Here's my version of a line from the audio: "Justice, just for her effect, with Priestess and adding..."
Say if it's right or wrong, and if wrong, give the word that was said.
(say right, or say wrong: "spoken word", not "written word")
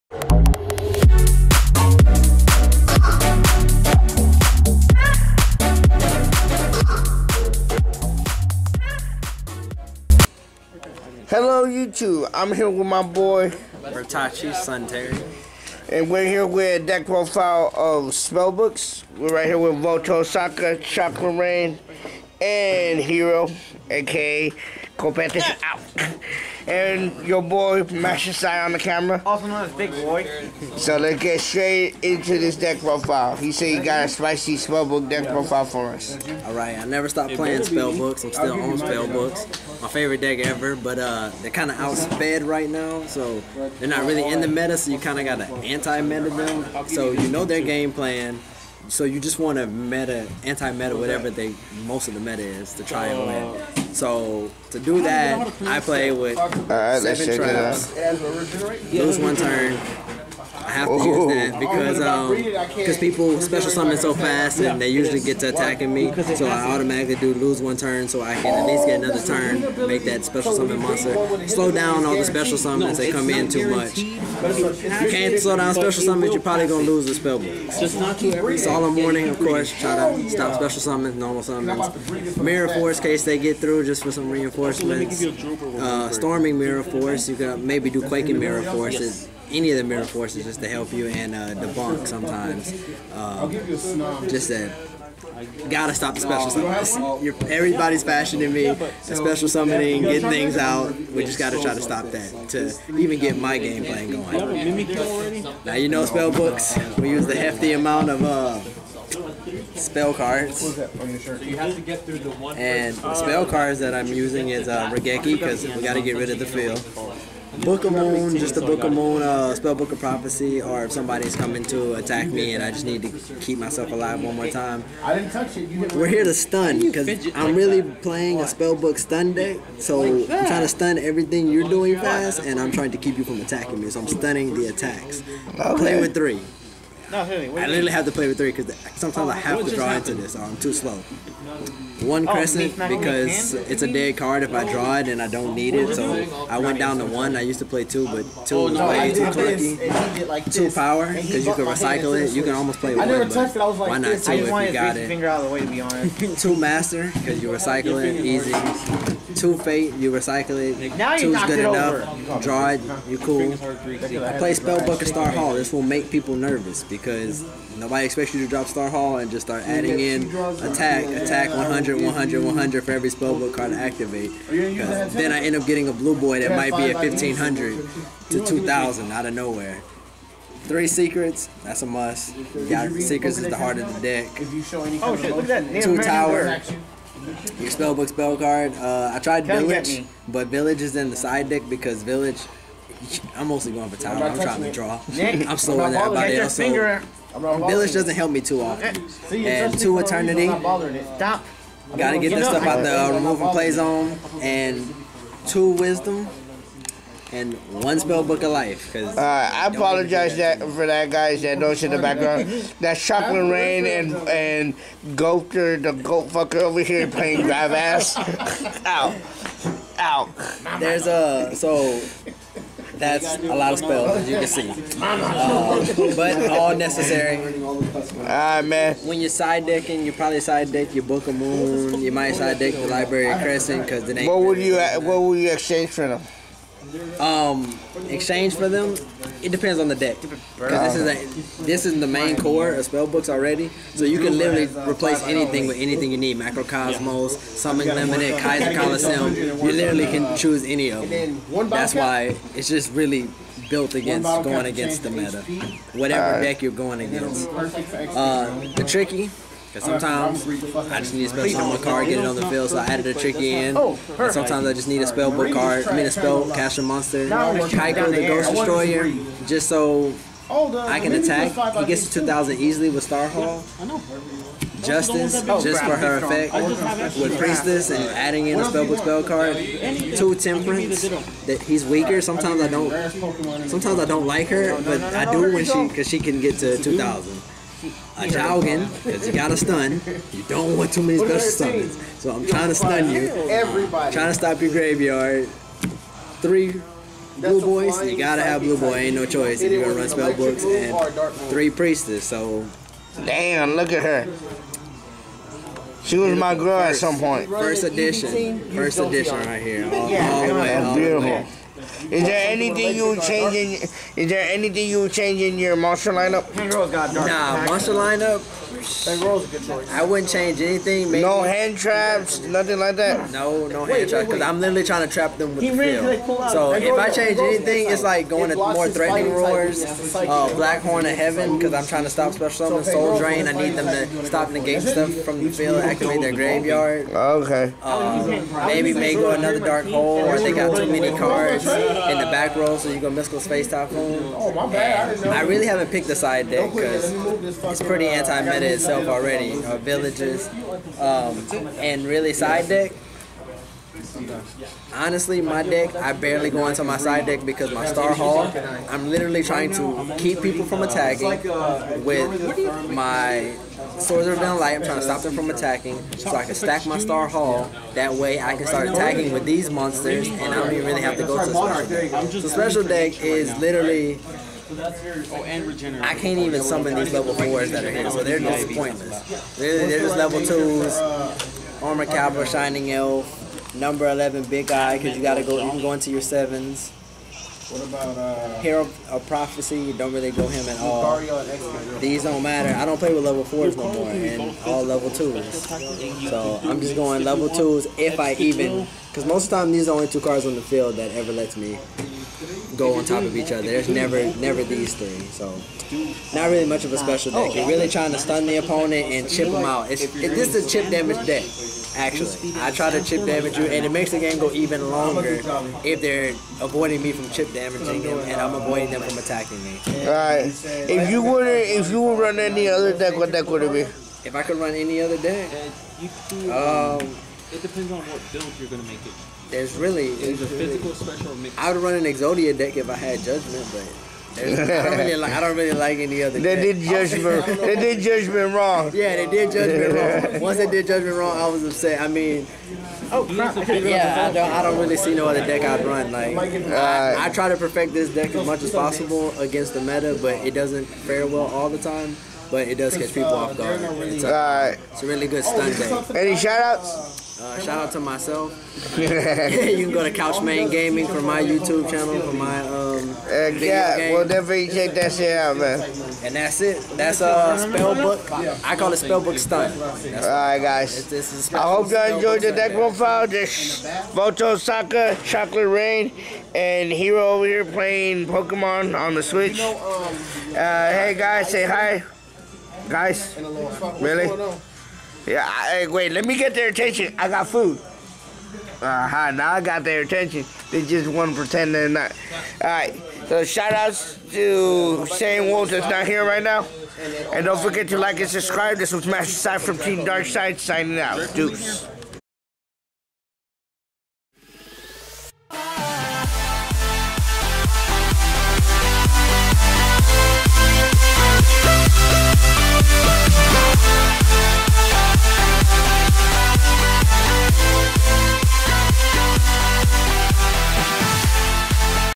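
right.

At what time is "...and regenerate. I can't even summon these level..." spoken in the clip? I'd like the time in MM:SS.
06:15.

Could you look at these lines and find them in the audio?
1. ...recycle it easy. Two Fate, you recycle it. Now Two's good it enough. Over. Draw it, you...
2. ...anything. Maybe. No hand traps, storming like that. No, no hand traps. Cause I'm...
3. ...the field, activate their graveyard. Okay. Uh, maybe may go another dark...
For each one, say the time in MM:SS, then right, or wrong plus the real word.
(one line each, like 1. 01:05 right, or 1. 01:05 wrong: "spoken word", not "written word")
1. 02:37 right
2. 05:20 wrong: "nothing", not "storming"
3. 05:35 right.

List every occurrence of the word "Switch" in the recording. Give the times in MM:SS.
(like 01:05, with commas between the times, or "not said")
07:59.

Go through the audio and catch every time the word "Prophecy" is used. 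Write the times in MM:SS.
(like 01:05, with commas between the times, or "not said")
01:59, 06:29.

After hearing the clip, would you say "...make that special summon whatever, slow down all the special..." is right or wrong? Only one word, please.
wrong.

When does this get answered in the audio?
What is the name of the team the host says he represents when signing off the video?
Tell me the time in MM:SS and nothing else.
08:19.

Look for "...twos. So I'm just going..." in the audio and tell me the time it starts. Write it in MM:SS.
06:35.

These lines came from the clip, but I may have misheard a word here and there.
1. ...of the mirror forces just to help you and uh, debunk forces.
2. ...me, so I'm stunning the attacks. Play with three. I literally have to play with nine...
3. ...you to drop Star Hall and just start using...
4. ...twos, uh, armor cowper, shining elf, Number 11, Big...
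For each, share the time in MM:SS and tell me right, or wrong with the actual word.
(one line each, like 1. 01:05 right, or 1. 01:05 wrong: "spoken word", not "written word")
1. 01:29 wrong: "sometimes", not "forces"
2. 02:13 wrong: "three", not "nine"
3. 02:48 wrong: "adding", not "using"
4. 06:20 right.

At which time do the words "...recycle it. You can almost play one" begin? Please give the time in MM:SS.
02:31.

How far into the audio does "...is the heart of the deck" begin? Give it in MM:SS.
03:03.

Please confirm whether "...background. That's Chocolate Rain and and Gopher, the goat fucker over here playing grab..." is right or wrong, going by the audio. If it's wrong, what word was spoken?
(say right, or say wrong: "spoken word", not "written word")
right.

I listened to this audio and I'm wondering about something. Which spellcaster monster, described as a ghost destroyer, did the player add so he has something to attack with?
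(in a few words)
Kycoo the Ghost Destroyer.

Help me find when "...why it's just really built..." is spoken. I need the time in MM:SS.
04:11.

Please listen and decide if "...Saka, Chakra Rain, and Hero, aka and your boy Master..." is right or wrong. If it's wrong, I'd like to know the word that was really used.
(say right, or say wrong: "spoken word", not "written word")
right.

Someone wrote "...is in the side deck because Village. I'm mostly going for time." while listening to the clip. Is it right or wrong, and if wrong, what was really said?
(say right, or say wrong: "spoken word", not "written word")
right.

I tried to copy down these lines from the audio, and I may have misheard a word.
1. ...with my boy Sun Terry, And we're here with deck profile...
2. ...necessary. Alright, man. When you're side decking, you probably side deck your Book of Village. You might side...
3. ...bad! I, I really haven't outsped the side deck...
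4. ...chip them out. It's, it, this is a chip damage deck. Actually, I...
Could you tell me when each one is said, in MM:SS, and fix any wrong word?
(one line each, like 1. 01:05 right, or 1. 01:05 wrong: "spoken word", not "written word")
1. 00:12 right
2. 03:46 wrong: "Moon", not "Village"
3. 05:44 wrong: "picked", not "outsped"
4. 06:49 right.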